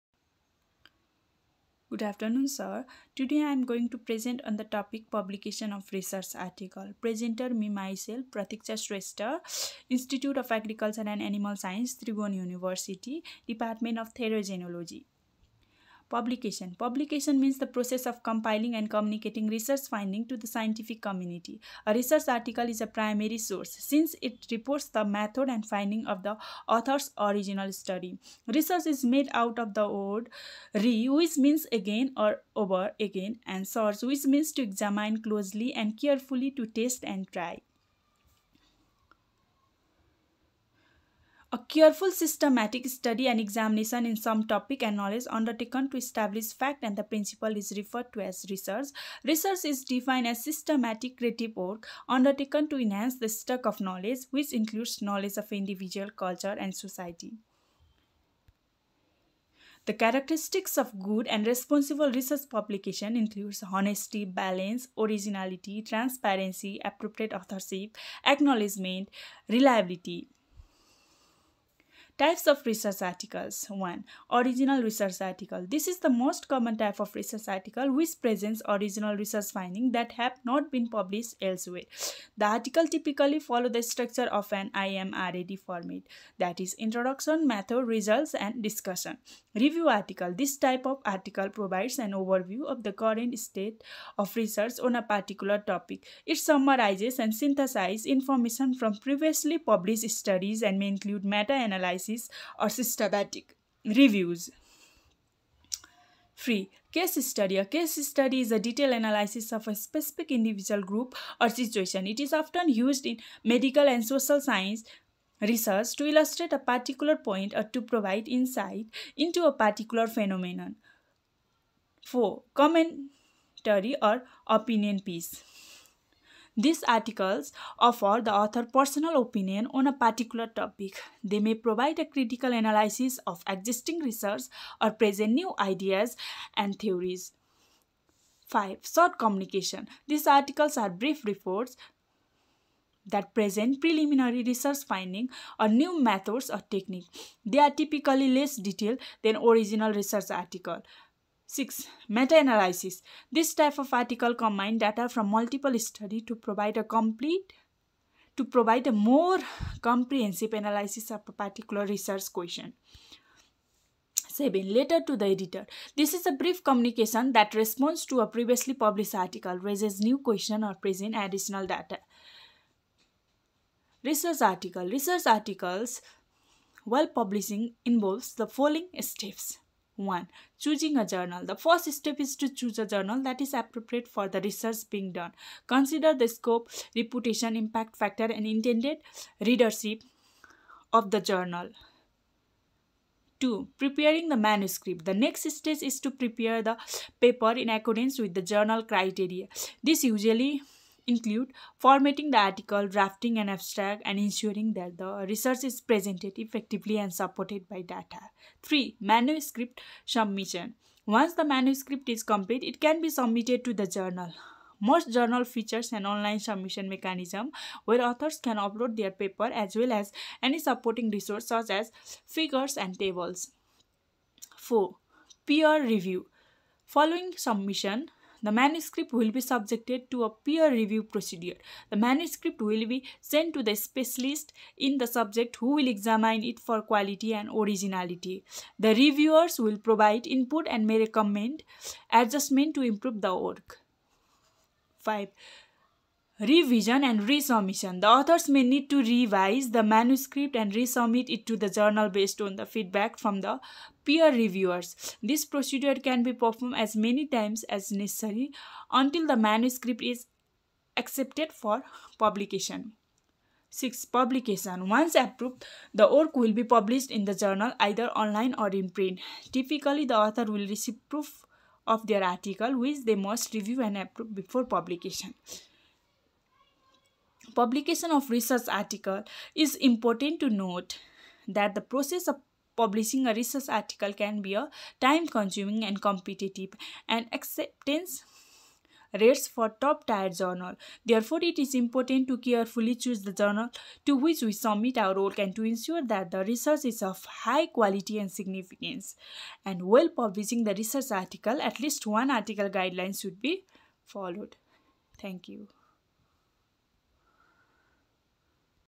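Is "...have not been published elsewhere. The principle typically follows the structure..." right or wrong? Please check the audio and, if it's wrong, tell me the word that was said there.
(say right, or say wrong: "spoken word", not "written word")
wrong: "article", not "principle".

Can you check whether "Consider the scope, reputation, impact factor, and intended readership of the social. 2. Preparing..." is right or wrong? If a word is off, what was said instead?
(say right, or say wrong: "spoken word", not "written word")
wrong: "journal", not "social".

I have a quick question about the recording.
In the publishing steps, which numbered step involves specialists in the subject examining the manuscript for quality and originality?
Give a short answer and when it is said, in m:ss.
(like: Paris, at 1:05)
4, at 3:44.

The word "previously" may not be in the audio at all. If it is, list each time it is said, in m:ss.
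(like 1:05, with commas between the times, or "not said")
1:38, 2:48.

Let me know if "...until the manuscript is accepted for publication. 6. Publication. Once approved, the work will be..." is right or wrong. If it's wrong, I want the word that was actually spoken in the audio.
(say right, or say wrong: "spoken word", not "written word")
right.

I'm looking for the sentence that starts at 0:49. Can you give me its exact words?
Research is defined as systematic creative work undertaken to enhance the stock of knowledge which includes knowledge of individual, culture and society.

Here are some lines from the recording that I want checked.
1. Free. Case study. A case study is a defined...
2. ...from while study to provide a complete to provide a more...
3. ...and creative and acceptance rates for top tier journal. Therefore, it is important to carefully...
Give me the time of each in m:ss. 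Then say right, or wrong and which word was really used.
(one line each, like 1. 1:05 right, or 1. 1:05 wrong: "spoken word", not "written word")
1. 1:46 wrong: "detailed", not "defined"
2. 2:35 wrong: "multiple", not "while"
3. 4:45 wrong: "competitive", not "creative".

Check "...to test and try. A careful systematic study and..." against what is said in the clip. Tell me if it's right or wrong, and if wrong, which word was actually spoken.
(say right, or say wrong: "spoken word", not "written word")
right.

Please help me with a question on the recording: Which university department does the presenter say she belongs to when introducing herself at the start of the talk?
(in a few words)
Therogenology.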